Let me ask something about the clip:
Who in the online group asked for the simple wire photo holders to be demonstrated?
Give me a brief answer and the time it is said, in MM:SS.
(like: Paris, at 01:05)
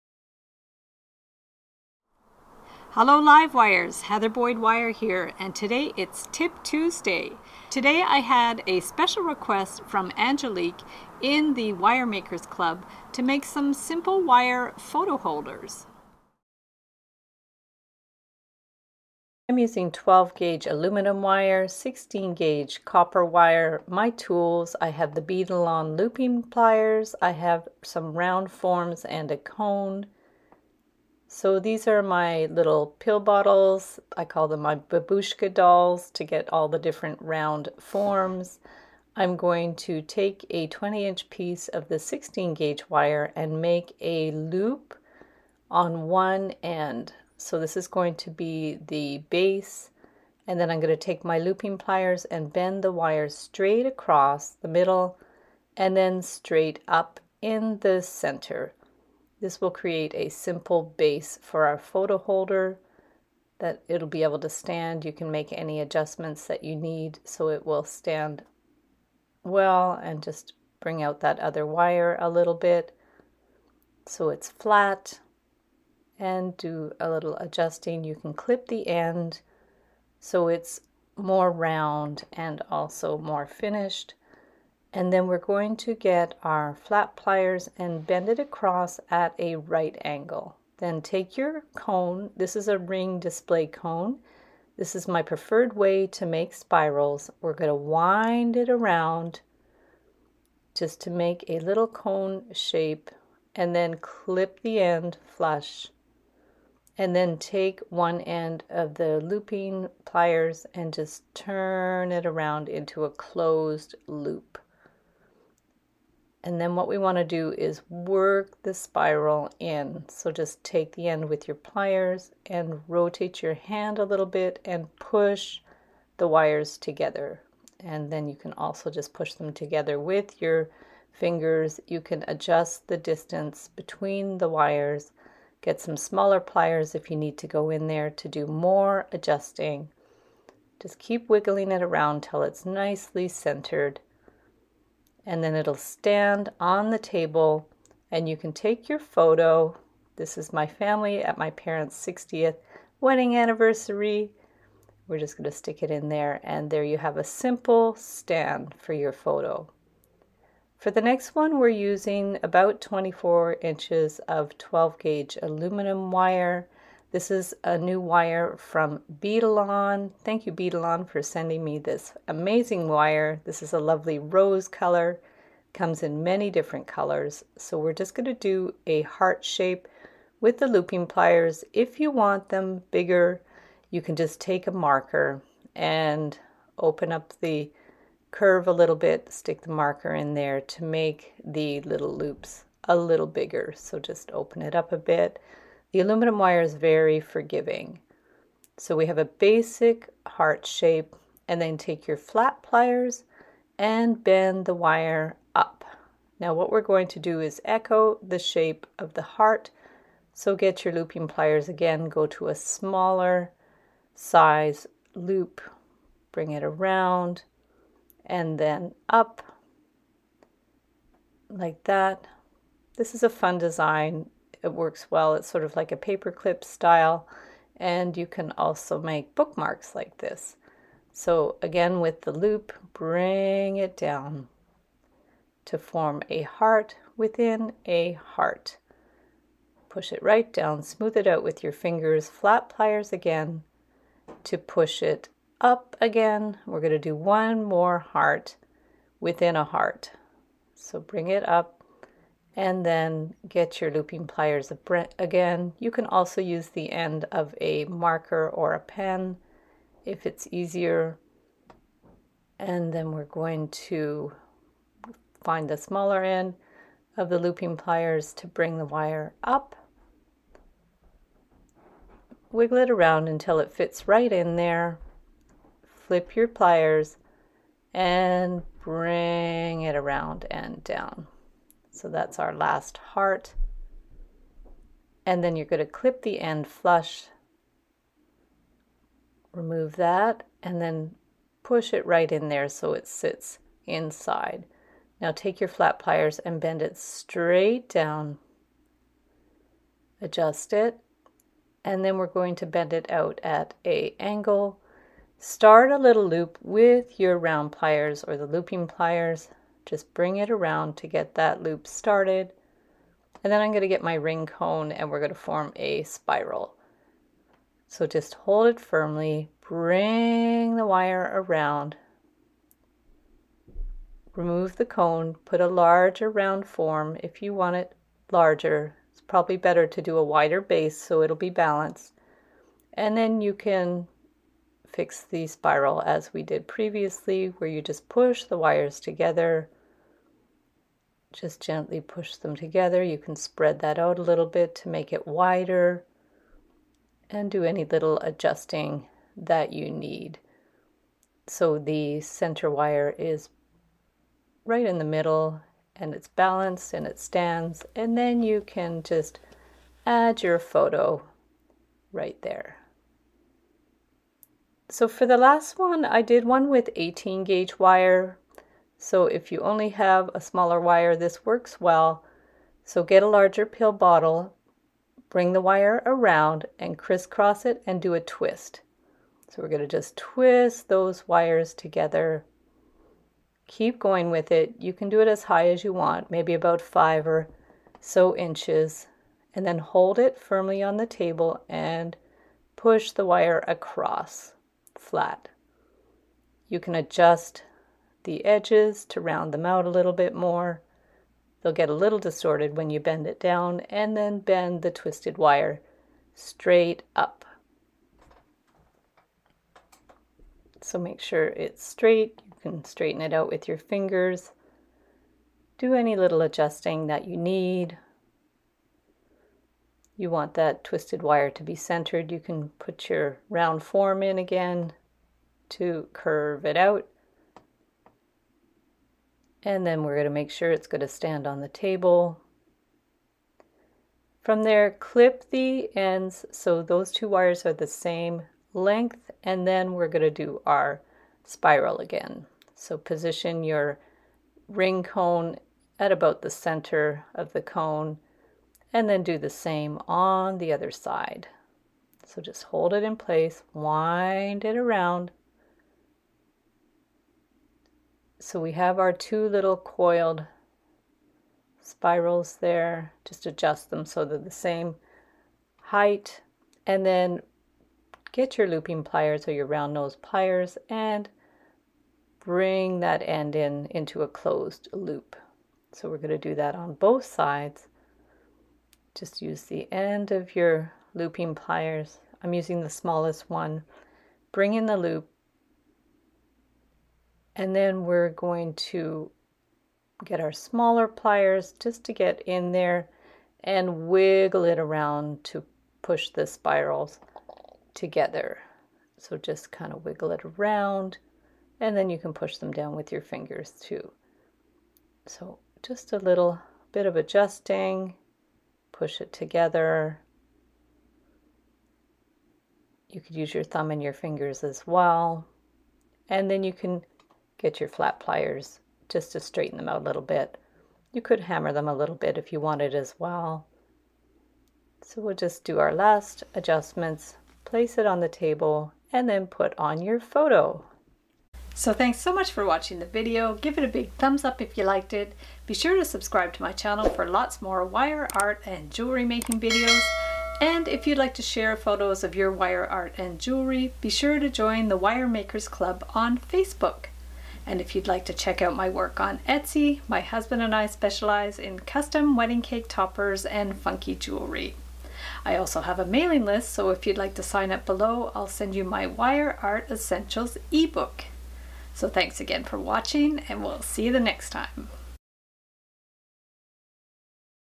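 Angelique, at 00:10.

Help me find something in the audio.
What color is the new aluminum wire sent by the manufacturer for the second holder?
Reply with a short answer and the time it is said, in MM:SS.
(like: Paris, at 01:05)
rose, at 02:54.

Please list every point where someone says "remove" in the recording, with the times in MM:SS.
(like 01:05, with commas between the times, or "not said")
04:49, 05:24.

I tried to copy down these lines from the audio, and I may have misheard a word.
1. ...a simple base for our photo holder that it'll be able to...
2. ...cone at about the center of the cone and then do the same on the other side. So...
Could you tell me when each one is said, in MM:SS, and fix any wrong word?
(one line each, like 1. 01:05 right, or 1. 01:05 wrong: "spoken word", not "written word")
1. 01:00 right
2. 07:25 right.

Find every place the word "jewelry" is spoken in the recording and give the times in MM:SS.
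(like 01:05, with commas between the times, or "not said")
08:58, 09:03, 09:14.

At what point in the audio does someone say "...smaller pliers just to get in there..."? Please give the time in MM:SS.
08:10.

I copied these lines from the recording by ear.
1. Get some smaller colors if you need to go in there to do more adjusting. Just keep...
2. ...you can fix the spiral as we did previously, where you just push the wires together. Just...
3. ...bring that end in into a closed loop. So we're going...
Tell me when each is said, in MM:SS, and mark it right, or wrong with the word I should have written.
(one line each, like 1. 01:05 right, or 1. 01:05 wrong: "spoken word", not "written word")
1. 02:15 wrong: "pliers", not "colors"
2. 05:33 right
3. 07:52 right.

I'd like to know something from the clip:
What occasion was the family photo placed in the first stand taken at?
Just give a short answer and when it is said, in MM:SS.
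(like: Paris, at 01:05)
60th wedding anniversary, at 02:32.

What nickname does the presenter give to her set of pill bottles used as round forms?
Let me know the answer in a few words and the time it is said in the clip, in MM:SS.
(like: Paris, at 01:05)
babushka dolls, at 00:34.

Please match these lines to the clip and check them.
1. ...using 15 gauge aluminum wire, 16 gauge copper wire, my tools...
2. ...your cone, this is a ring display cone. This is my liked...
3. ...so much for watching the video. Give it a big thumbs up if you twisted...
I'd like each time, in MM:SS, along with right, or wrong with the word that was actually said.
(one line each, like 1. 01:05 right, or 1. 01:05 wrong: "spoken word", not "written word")
1. 00:19 wrong: "12", not "15"
2. 01:31 wrong: "preferred", not "liked"
3. 08:52 wrong: "liked", not "twisted".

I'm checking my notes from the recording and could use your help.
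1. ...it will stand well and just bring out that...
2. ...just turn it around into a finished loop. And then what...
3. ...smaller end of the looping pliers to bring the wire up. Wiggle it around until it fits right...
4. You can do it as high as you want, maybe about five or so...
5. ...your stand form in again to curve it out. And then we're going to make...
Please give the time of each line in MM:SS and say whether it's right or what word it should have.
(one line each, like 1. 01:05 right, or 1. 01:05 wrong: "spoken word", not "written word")
1. 01:07 right
2. 01:50 wrong: "closed", not "finished"
3. 04:25 right
4. 06:24 right
5. 07:03 wrong: "round", not "stand".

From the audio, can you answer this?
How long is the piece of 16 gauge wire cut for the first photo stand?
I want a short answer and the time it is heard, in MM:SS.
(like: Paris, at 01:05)
20 inches, at 00:40.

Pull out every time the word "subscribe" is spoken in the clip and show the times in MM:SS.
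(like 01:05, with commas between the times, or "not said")
08:56.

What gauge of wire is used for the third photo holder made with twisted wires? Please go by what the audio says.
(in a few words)
18 gauge.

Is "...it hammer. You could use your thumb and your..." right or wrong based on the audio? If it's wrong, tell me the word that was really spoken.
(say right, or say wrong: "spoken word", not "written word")
wrong: "together", not "hammer".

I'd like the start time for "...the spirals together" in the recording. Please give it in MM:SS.
08:16.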